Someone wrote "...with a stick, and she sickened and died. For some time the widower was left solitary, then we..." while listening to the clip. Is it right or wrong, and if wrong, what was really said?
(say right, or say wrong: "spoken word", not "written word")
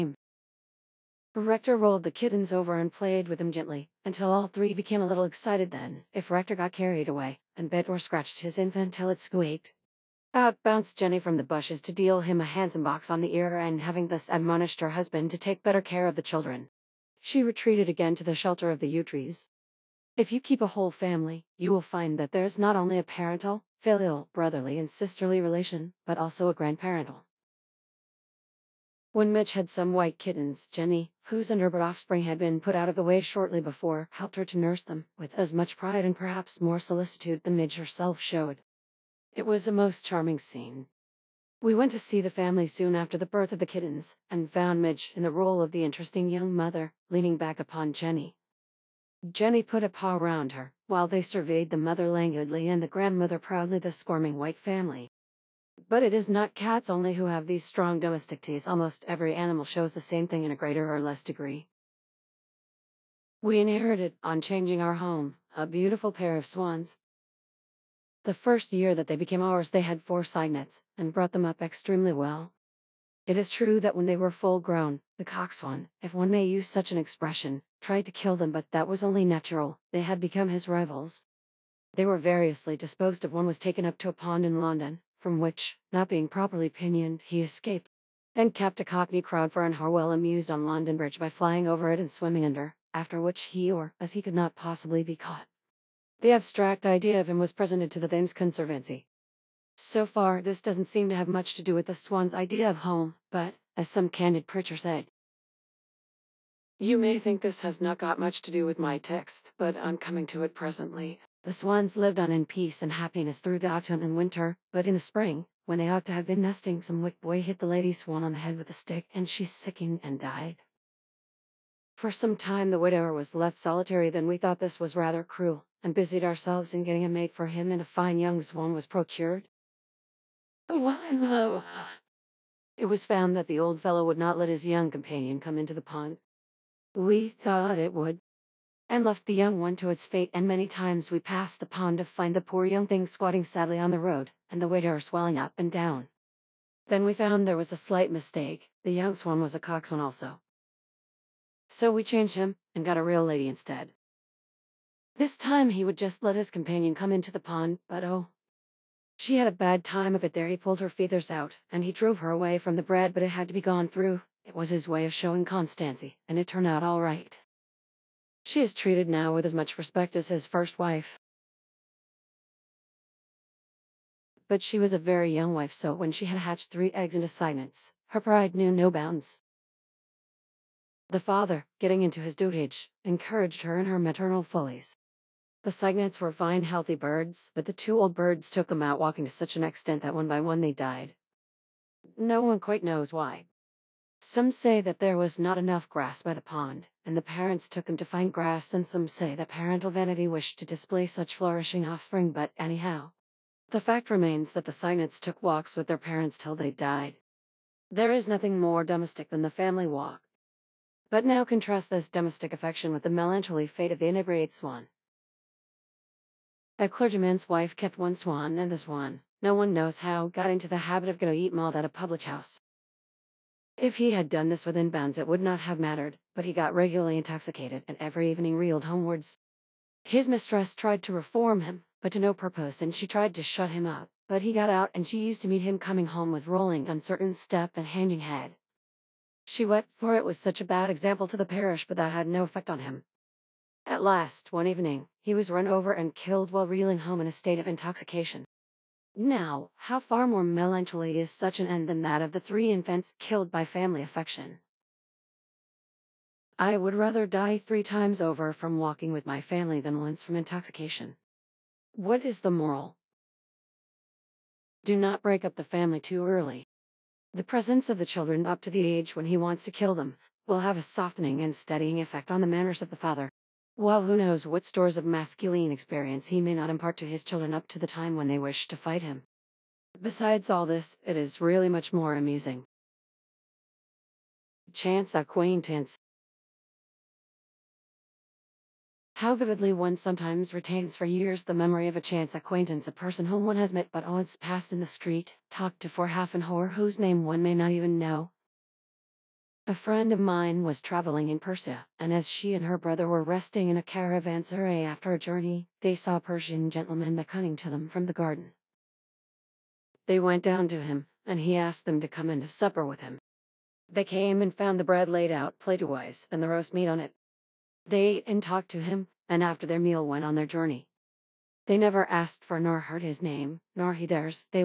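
right.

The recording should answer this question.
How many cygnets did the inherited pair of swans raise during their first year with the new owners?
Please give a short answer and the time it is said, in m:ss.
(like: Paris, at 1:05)
4, at 1:10.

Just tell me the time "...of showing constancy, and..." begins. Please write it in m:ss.
2:45.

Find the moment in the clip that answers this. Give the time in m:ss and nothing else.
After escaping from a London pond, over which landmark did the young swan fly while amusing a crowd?
1:30.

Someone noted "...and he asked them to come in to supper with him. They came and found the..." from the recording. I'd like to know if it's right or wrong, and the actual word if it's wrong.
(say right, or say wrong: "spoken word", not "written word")
right.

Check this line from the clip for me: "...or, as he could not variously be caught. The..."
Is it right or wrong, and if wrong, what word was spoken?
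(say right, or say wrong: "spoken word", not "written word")
wrong: "possibly", not "variously".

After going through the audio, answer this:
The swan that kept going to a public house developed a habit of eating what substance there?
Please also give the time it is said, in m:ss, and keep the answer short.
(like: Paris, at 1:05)
Malt, at 3:41.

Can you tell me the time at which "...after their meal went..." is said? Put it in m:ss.
5:19.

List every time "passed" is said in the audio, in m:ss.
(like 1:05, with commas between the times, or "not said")
2:21, 4:54.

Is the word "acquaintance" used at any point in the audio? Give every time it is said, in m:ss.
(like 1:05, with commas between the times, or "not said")
4:45, 4:52.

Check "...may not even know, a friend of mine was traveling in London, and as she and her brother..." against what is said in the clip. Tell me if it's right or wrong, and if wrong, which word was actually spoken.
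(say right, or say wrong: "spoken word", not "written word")
wrong: "Persia", not "London".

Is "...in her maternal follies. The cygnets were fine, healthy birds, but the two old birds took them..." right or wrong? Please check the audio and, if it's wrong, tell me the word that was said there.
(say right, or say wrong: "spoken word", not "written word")
right.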